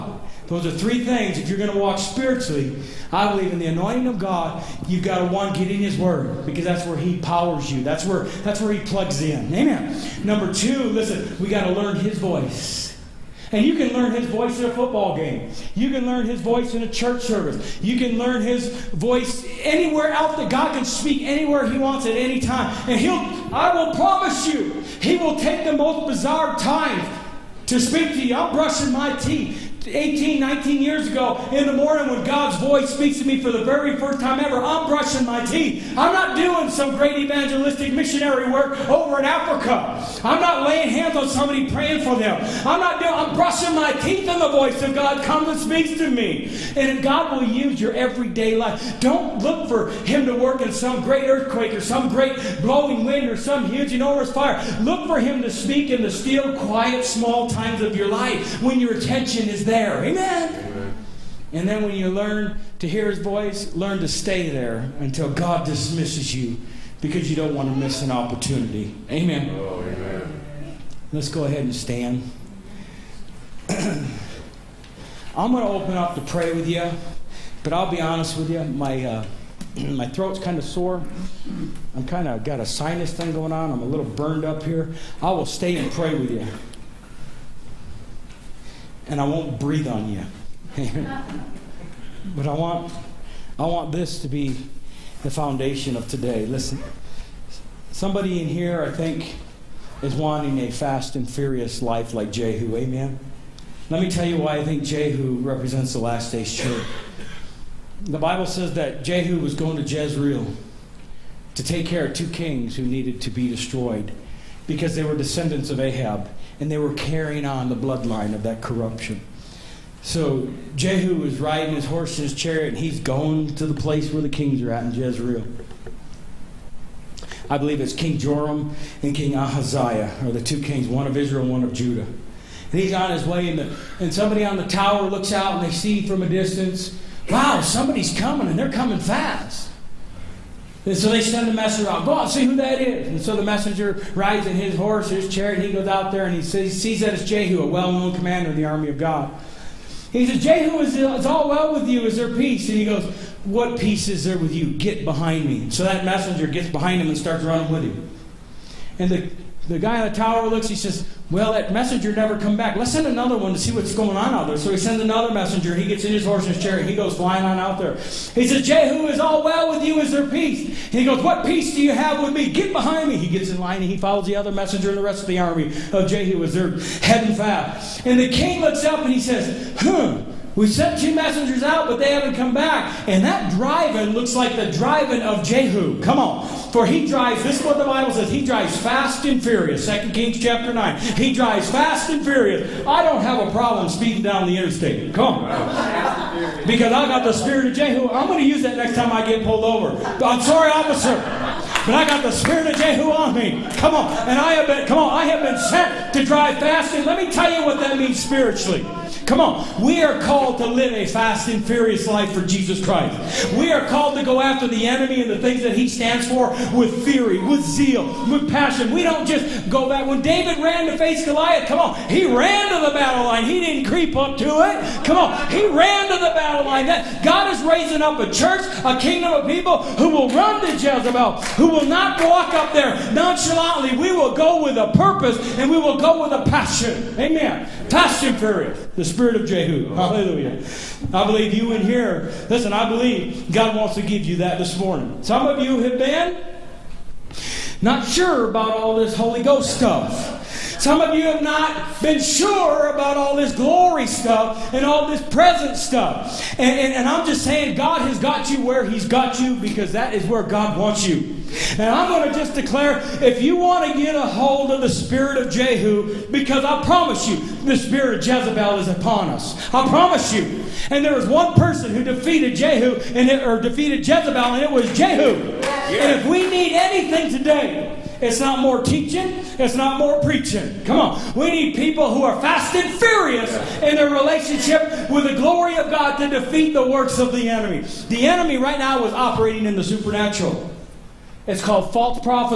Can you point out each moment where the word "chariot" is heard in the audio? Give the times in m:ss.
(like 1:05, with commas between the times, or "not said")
2:02, 2:25, 2:46.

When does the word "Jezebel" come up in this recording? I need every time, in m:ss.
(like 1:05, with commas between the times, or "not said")
3:50, 4:28, 4:34.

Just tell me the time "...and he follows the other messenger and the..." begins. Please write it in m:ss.
2:53.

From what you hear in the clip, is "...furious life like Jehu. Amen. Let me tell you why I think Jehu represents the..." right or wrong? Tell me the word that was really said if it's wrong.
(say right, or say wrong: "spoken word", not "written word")
right.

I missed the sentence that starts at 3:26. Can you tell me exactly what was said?
And let me tell you what that means spiritually.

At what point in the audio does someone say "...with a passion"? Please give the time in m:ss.
3:56.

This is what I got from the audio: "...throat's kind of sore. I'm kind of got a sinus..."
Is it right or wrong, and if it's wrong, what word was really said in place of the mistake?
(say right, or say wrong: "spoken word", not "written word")
right.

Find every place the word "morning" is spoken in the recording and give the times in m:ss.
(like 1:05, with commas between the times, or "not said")
0:31, 4:04.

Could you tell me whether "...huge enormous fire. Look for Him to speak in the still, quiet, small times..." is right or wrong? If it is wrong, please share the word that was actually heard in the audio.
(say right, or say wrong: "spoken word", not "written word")
right.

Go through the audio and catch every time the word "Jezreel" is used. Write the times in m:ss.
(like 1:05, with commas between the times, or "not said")
1:49, 2:04.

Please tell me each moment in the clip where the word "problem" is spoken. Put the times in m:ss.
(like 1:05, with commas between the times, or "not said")
3:13.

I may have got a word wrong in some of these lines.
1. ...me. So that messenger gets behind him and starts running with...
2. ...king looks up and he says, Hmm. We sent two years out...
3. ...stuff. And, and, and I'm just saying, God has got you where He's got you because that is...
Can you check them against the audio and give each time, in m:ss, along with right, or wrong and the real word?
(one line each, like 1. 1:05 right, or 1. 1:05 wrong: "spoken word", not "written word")
1. 2:35 right
2. 2:58 wrong: "messengers", not "years"
3. 4:15 right.